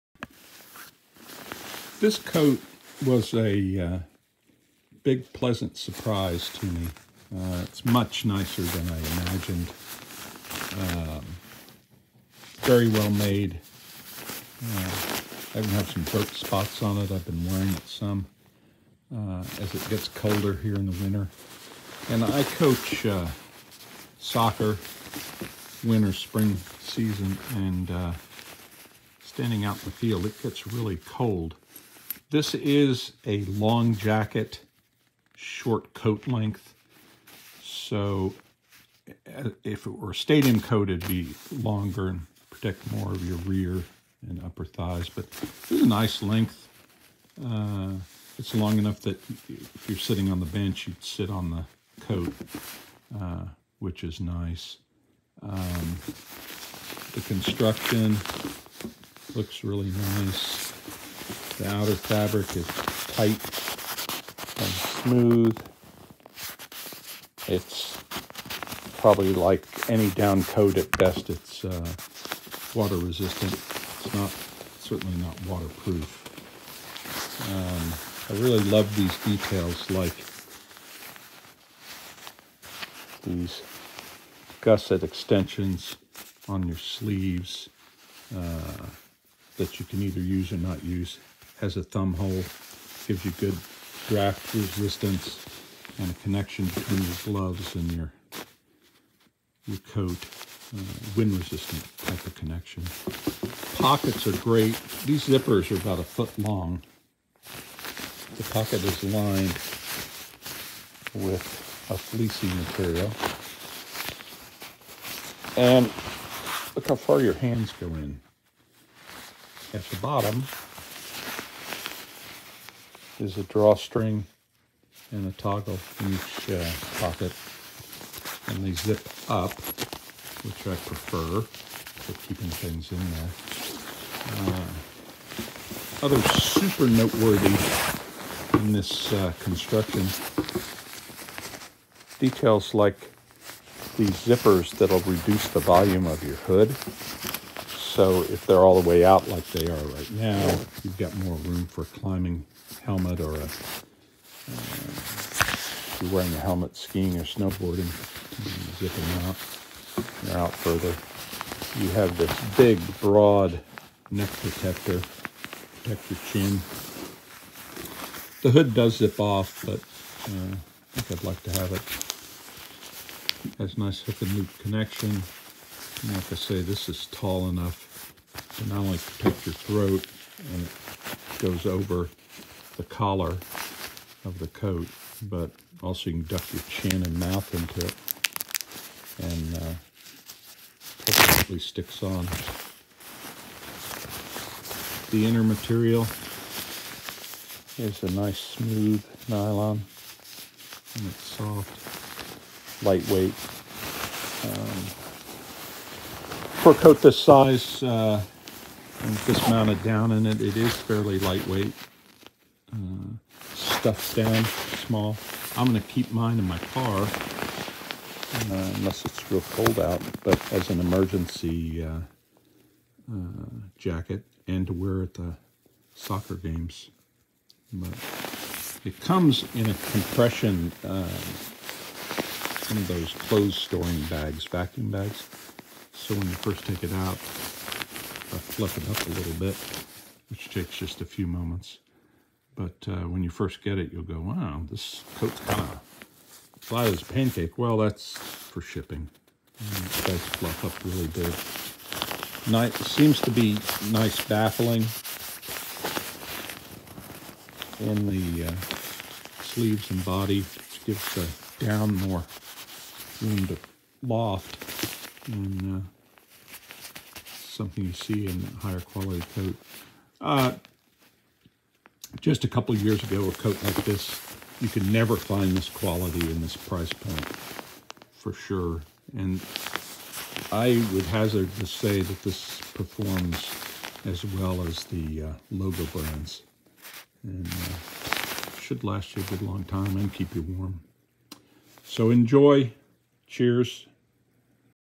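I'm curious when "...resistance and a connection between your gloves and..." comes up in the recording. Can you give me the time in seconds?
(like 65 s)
94 s.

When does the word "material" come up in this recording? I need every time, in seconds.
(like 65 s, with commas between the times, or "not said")
112 s, 195 s.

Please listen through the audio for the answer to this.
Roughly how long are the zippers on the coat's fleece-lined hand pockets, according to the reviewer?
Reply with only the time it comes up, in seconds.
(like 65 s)
105 s.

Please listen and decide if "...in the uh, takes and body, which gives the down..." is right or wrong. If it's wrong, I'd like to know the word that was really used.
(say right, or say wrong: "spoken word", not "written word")
wrong: "sleeves", not "takes".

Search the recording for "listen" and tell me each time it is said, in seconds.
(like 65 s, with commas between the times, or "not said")
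not said.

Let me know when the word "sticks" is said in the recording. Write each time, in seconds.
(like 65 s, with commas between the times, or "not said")
191 s.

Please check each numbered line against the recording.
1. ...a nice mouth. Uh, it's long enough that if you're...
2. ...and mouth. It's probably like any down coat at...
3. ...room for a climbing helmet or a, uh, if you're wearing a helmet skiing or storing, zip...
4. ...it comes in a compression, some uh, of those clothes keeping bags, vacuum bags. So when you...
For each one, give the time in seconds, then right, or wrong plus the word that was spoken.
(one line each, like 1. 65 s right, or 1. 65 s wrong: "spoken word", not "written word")
1. 45 s wrong: "length", not "mouth"
2. 64 s wrong: "smooth", not "mouth"
3. 151 s wrong: "snowboarding", not "storing"
4. 228 s wrong: "storing", not "keeping".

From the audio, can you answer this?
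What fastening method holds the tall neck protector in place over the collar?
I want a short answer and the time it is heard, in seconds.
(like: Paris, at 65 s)
hook and loop, at 173 s.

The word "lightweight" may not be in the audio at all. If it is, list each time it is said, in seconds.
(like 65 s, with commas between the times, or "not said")
202 s, 211 s.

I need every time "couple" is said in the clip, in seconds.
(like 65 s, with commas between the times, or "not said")
272 s.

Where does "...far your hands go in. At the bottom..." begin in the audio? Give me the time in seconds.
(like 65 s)
116 s.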